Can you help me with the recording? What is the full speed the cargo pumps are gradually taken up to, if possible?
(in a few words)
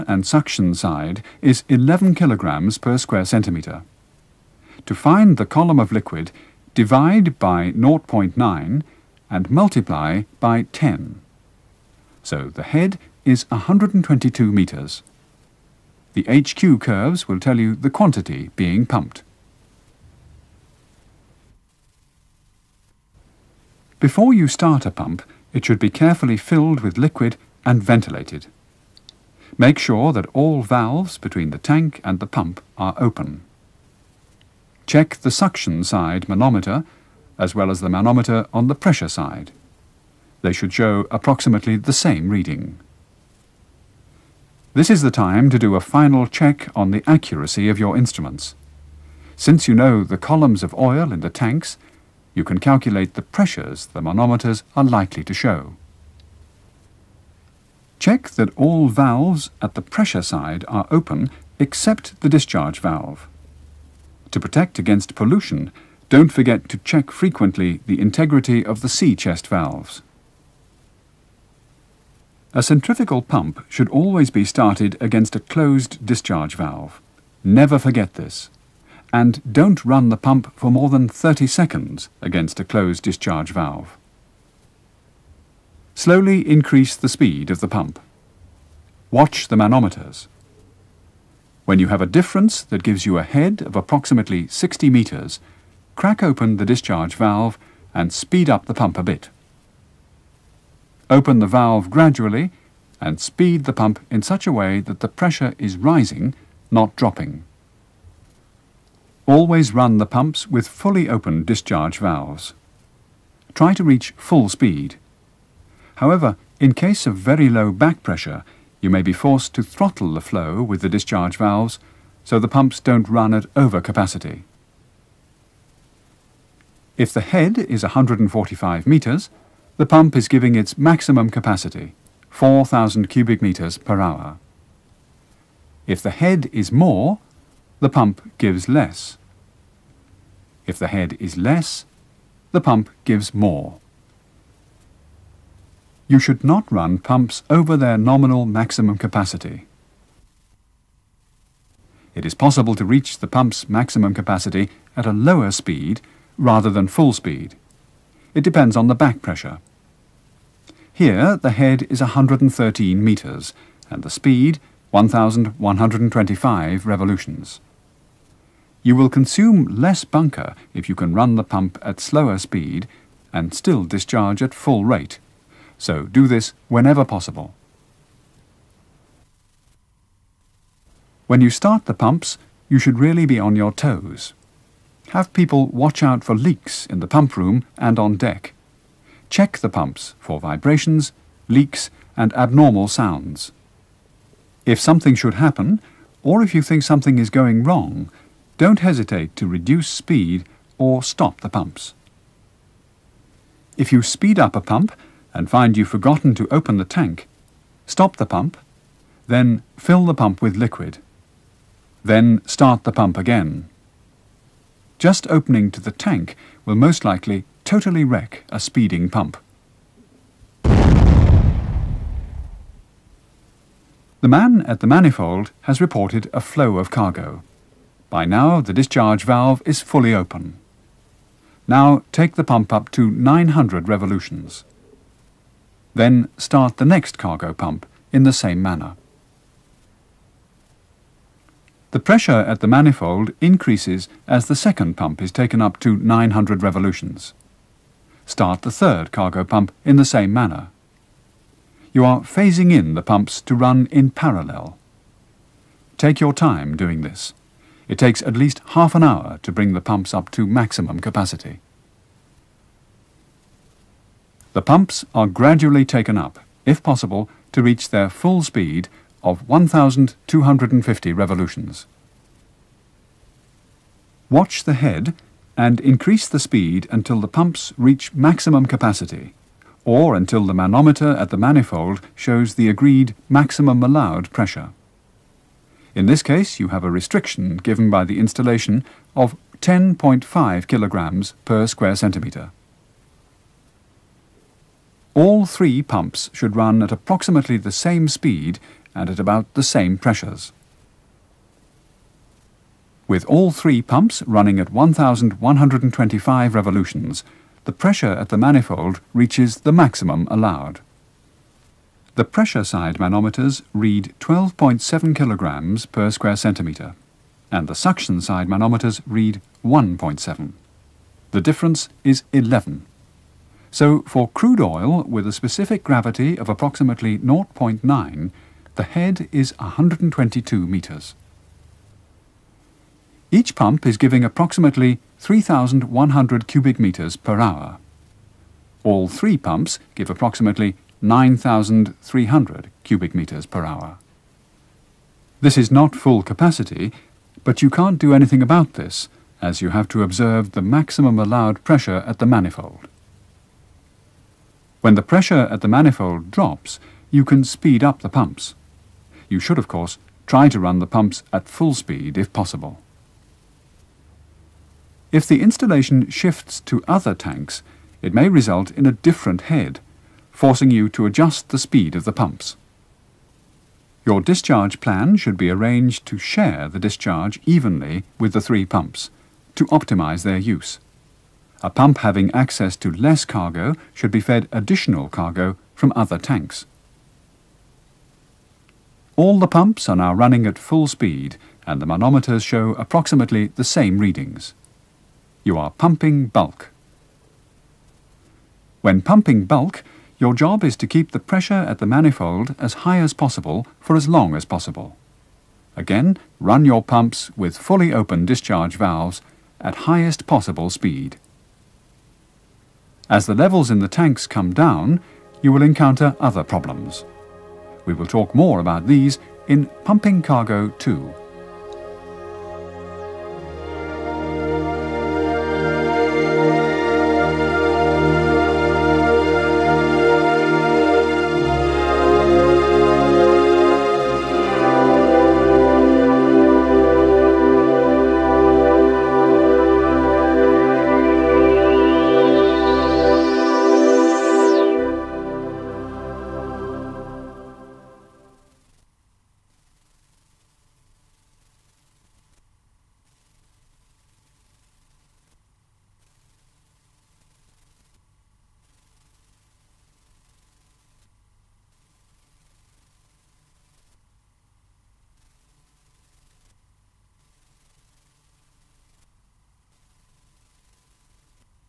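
1,250 revolutions.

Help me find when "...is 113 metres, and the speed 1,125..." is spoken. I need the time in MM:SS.
02:41.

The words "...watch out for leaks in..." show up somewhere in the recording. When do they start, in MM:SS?
03:05.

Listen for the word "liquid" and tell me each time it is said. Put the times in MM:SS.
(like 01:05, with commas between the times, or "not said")
00:05, 00:26, 03:30.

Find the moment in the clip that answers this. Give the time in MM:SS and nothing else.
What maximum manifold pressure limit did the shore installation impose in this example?
04:49.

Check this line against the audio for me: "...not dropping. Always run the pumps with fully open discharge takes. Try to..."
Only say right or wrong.
wrong.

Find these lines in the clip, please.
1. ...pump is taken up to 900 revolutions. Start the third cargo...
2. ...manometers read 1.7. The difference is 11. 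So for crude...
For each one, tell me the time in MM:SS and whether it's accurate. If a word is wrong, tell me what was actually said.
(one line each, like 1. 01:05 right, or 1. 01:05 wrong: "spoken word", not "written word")
1. 04:04 right
2. 05:18 right.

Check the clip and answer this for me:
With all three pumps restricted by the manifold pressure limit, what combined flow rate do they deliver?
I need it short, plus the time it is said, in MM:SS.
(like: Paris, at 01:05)
9,300 cubic metres per hour, at 05:41.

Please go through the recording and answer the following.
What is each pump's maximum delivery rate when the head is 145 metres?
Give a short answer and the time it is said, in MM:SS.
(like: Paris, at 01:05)
4,000 cubic meters per hour, at 02:12.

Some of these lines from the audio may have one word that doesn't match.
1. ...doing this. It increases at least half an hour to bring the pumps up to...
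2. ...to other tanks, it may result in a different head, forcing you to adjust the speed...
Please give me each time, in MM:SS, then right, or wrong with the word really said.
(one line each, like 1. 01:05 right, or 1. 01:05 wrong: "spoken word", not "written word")
1. 04:16 wrong: "takes", not "increases"
2. 06:06 right.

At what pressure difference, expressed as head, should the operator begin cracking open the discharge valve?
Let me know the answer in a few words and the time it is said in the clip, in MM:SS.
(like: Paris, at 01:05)
60 metres, at 01:34.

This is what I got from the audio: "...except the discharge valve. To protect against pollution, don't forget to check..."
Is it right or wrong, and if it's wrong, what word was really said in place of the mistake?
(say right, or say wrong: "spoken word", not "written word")
right.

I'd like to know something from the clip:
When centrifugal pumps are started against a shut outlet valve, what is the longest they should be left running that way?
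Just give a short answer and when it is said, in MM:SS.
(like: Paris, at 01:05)
30 seconds, at 01:21.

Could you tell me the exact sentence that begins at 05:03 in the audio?
With all three pumps running at 1,125 revolutions, the pressure at the manifold reaches the maximum allowed.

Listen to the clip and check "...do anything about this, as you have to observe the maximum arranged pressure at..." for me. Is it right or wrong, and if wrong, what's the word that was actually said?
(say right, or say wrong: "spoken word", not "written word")
wrong: "allowed", not "arranged".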